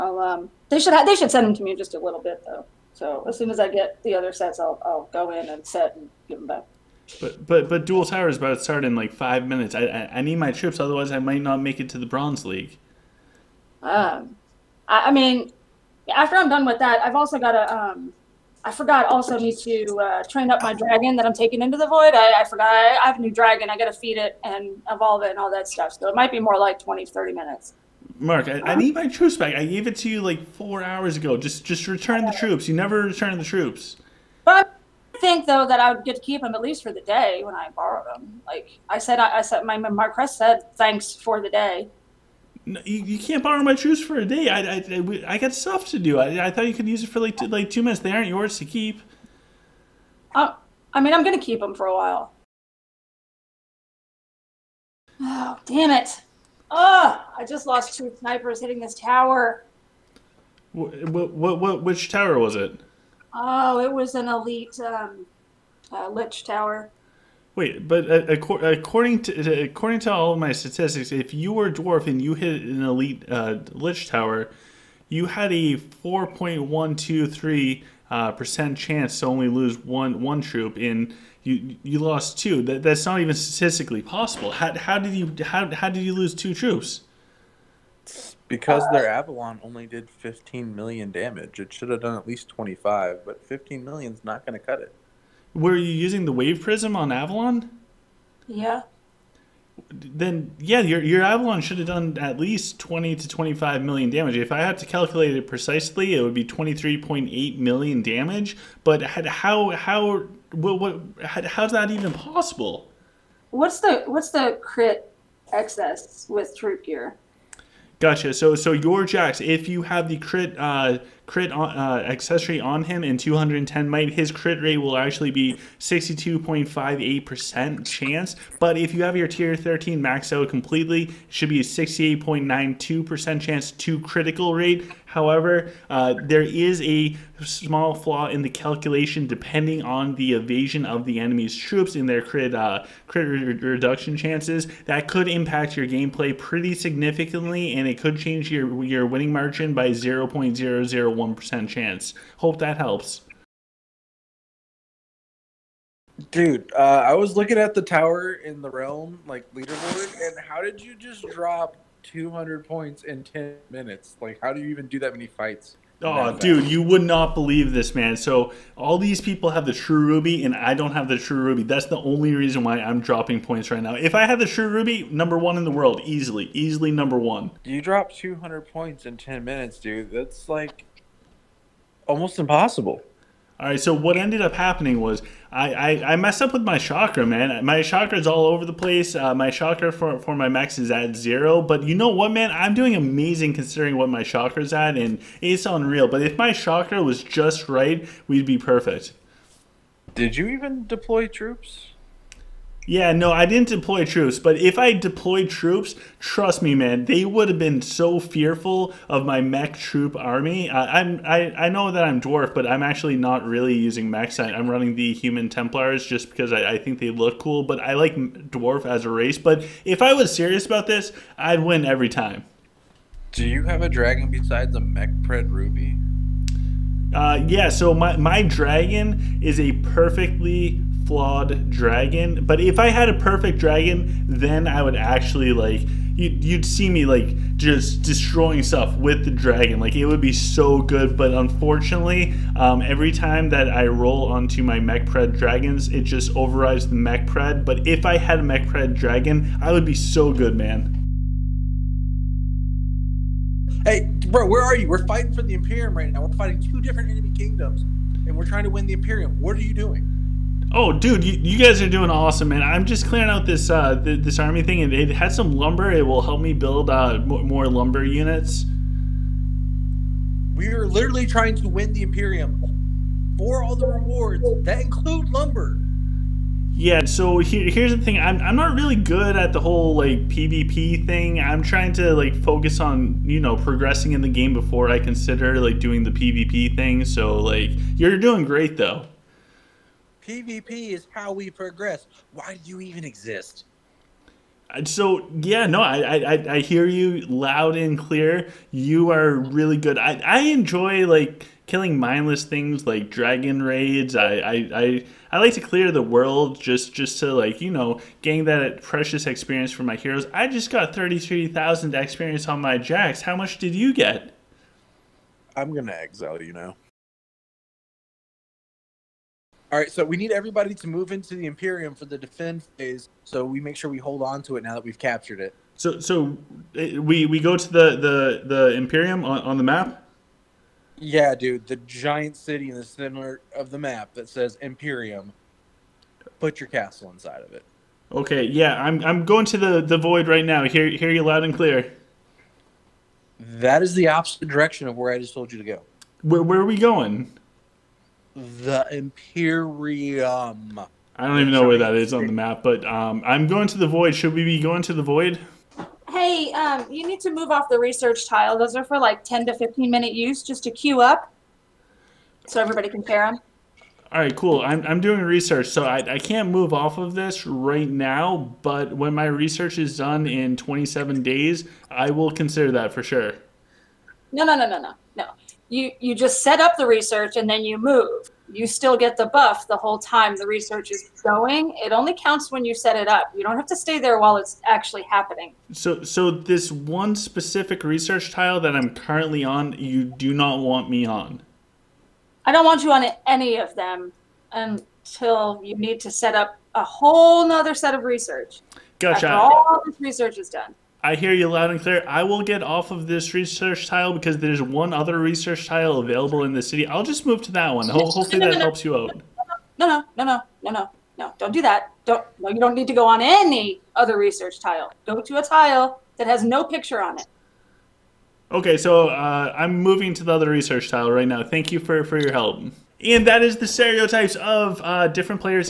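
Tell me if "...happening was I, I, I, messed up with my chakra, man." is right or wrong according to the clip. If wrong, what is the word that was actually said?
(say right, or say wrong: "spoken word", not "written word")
right.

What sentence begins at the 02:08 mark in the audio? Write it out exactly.
But if you have your tier 13 maxed out completely, it should be a 68.92% chance to critical rate.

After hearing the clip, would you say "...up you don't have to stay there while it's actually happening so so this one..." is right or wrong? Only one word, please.
right.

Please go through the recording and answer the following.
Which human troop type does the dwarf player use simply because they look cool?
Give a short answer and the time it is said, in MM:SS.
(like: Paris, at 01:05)
Templars, at 03:35.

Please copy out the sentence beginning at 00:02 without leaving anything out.
So as soon as I get the other sets, I'll I'll go in and set and give them back.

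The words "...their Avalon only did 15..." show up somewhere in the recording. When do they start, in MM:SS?
01:28.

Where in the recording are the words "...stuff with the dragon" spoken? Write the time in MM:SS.
03:58.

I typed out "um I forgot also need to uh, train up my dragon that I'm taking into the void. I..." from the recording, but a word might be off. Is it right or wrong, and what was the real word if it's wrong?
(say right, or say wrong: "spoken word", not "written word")
right.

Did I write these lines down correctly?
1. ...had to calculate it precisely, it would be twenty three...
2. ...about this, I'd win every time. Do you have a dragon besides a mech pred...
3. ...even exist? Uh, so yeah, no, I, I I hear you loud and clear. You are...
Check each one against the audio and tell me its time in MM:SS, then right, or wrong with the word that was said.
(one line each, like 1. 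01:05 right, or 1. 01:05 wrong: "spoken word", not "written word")
1. 01:44 right
2. 03:40 right
3. 04:52 right.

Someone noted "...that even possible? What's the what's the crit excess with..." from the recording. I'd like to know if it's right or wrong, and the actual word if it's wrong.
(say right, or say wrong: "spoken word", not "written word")
right.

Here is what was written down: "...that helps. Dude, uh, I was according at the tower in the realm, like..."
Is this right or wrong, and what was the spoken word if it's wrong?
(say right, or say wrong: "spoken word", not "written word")
wrong: "looking", not "according".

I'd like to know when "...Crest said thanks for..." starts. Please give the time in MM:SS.
00:40.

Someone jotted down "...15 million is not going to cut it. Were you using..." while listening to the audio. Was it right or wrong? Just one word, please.
right.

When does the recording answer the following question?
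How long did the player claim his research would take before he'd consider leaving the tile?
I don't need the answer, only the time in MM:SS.
06:10.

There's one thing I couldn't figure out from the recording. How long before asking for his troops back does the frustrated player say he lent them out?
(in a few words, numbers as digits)
4 hours.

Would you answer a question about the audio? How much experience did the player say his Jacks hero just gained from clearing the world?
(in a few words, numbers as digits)
33,000.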